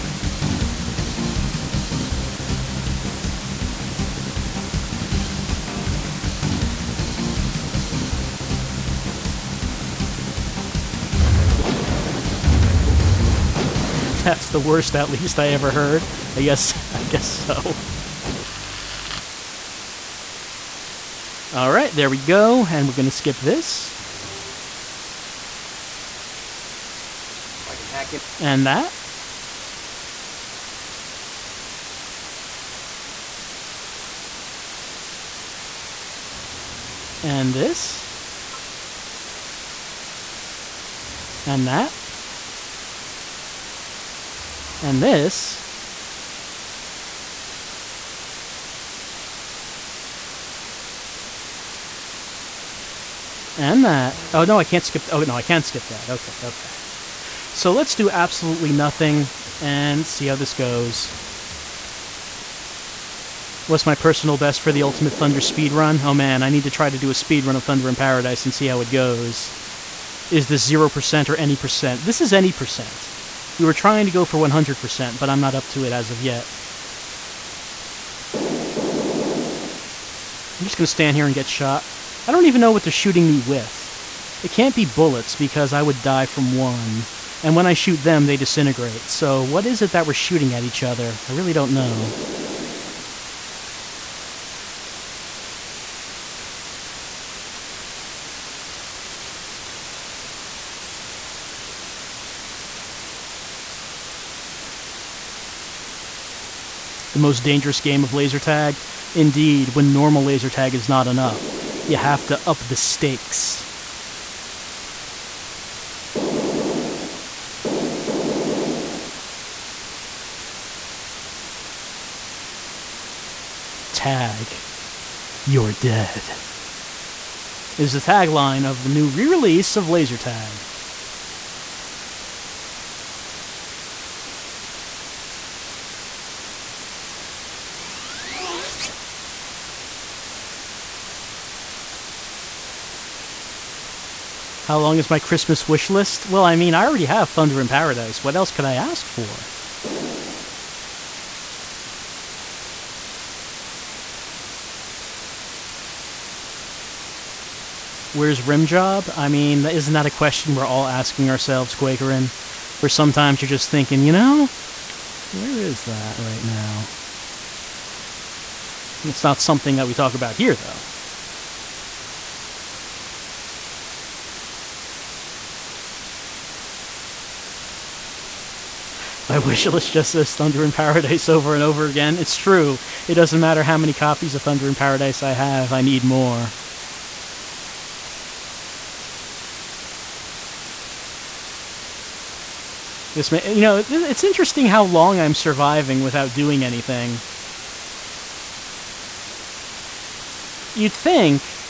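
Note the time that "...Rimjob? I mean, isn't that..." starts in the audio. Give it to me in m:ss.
2:38.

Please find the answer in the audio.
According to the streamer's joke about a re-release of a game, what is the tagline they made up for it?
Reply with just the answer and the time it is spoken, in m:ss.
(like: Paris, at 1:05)
Tag, you're dead, at 2:03.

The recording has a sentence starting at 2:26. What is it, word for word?
Well, I mean, I already have Thunder in Paradise.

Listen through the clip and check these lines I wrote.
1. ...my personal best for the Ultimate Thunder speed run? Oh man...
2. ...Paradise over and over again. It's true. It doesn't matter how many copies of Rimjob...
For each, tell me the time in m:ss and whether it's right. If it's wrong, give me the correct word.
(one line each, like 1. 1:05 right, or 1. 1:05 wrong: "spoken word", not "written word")
1. 1:03 right
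2. 3:00 wrong: "Thunder", not "Rimjob".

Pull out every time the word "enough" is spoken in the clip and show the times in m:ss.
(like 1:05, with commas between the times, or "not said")
1:51.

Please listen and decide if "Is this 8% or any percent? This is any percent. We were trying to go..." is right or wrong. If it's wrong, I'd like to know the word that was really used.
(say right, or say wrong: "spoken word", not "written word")
wrong: "0", not "8".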